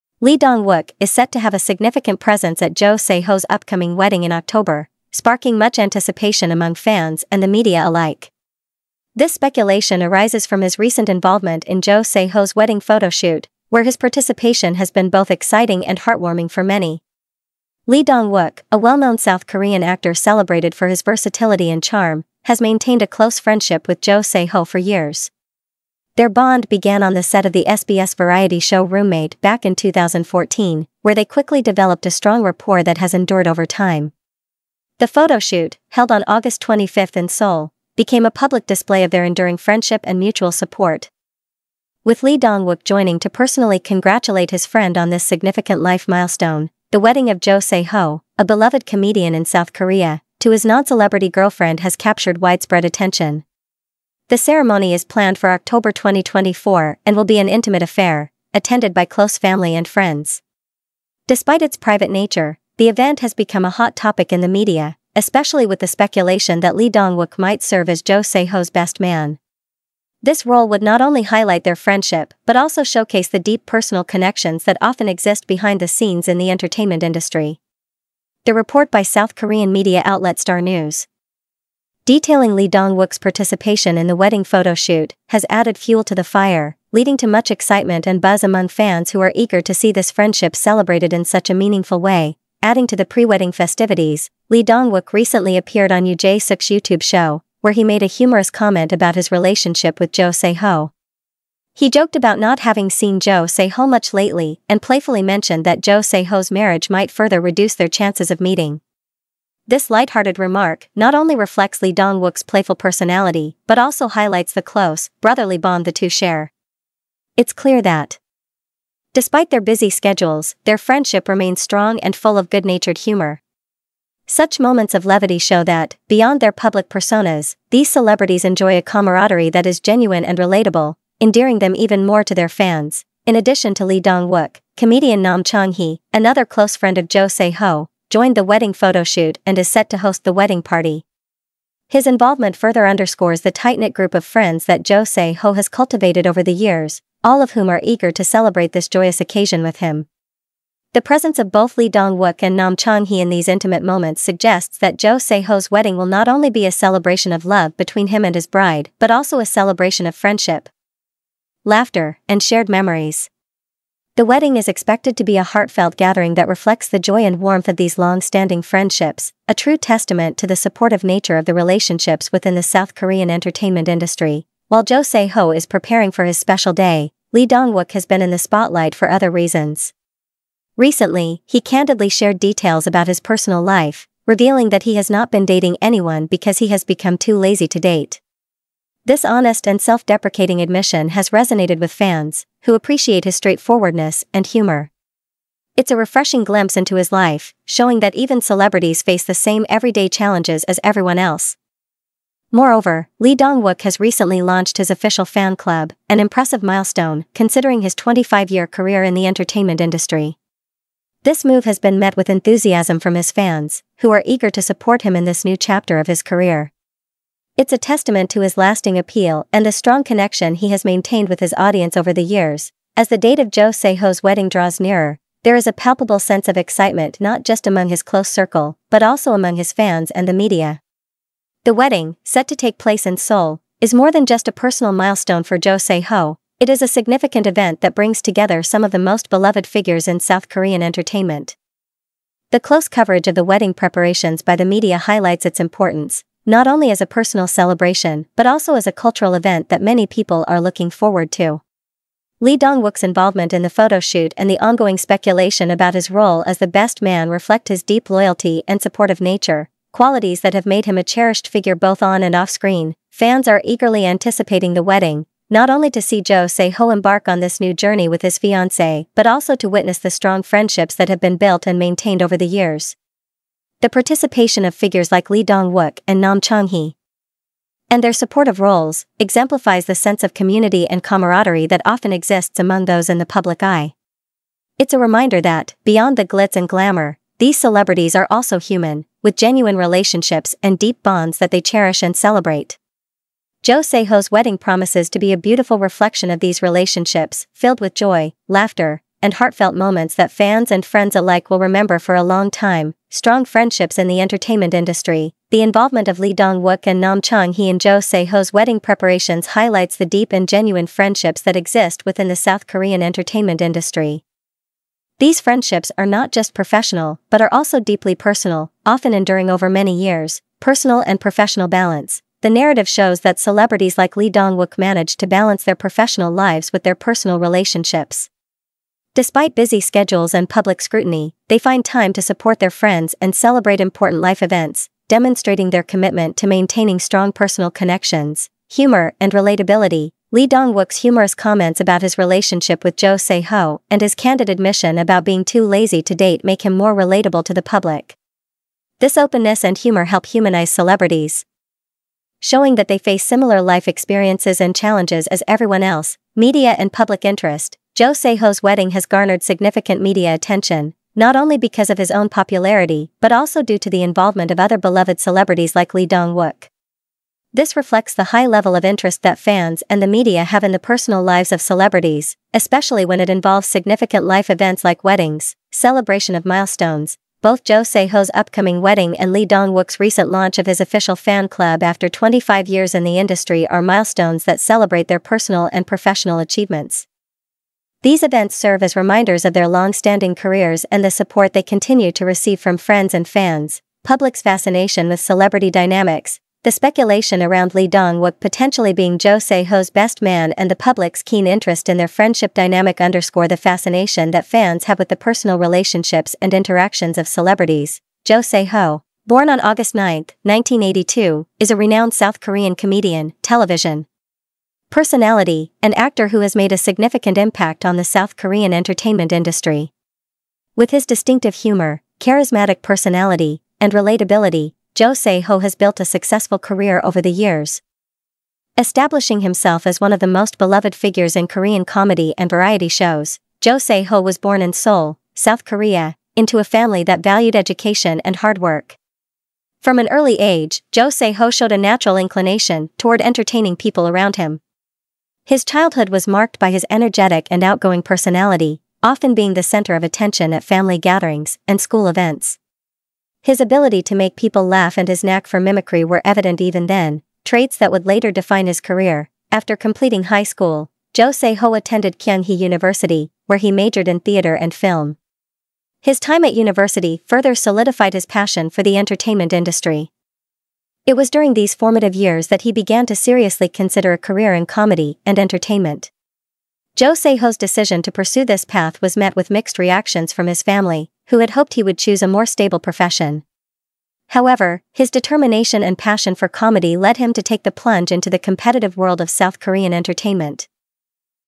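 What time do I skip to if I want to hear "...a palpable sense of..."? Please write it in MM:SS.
03:45.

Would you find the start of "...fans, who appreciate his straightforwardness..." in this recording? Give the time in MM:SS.
03:11.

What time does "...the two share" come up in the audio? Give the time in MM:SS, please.
01:55.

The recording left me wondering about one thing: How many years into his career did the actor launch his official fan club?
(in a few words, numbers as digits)
25.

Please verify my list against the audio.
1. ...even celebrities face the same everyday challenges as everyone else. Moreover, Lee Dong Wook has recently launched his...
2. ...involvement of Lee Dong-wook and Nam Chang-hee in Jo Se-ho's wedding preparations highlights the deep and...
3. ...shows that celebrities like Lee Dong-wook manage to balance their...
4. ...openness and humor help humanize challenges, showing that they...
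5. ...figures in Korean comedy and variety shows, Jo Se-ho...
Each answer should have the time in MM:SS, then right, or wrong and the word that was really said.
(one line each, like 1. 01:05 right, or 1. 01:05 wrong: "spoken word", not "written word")
1. 03:18 right
2. 05:05 right
3. 05:22 right
4. 05:49 wrong: "celebrities", not "challenges"
5. 07:10 right.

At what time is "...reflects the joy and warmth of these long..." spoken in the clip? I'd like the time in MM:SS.
02:46.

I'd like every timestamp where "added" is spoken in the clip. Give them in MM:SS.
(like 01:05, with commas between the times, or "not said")
01:25.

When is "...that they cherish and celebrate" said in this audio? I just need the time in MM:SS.
04:51.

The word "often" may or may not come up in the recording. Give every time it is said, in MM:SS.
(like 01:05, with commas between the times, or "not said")
01:14, 04:41, 05:18, 07:29.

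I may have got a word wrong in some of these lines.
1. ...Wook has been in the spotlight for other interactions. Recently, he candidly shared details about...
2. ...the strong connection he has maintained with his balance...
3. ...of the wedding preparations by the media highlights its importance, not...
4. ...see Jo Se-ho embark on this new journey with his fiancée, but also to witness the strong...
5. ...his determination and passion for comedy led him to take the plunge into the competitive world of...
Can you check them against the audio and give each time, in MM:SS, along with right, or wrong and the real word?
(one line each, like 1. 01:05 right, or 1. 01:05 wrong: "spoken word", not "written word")
1. 02:57 wrong: "reasons", not "interactions"
2. 03:39 wrong: "audience", not "balance"
3. 04:03 right
4. 04:26 right
5. 08:04 right.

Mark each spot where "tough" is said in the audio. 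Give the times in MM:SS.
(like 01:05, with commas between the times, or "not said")
not said.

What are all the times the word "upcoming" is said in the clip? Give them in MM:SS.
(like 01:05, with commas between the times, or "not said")
00:03, 06:18.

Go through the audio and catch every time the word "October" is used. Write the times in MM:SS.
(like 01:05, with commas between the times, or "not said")
00:04, 00:55.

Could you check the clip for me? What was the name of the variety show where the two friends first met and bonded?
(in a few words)
Roommate.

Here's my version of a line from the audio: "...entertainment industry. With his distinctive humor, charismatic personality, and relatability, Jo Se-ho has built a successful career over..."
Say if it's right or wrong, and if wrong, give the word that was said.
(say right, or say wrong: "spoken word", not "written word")
right.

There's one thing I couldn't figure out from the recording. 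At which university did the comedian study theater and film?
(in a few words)
Kyunghee University.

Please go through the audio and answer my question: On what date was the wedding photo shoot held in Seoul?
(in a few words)
August 25.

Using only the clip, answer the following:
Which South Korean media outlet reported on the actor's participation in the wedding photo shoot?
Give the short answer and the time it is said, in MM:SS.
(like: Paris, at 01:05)
Star News, at 01:20.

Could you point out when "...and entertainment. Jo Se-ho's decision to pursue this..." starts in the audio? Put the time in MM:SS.
07:55.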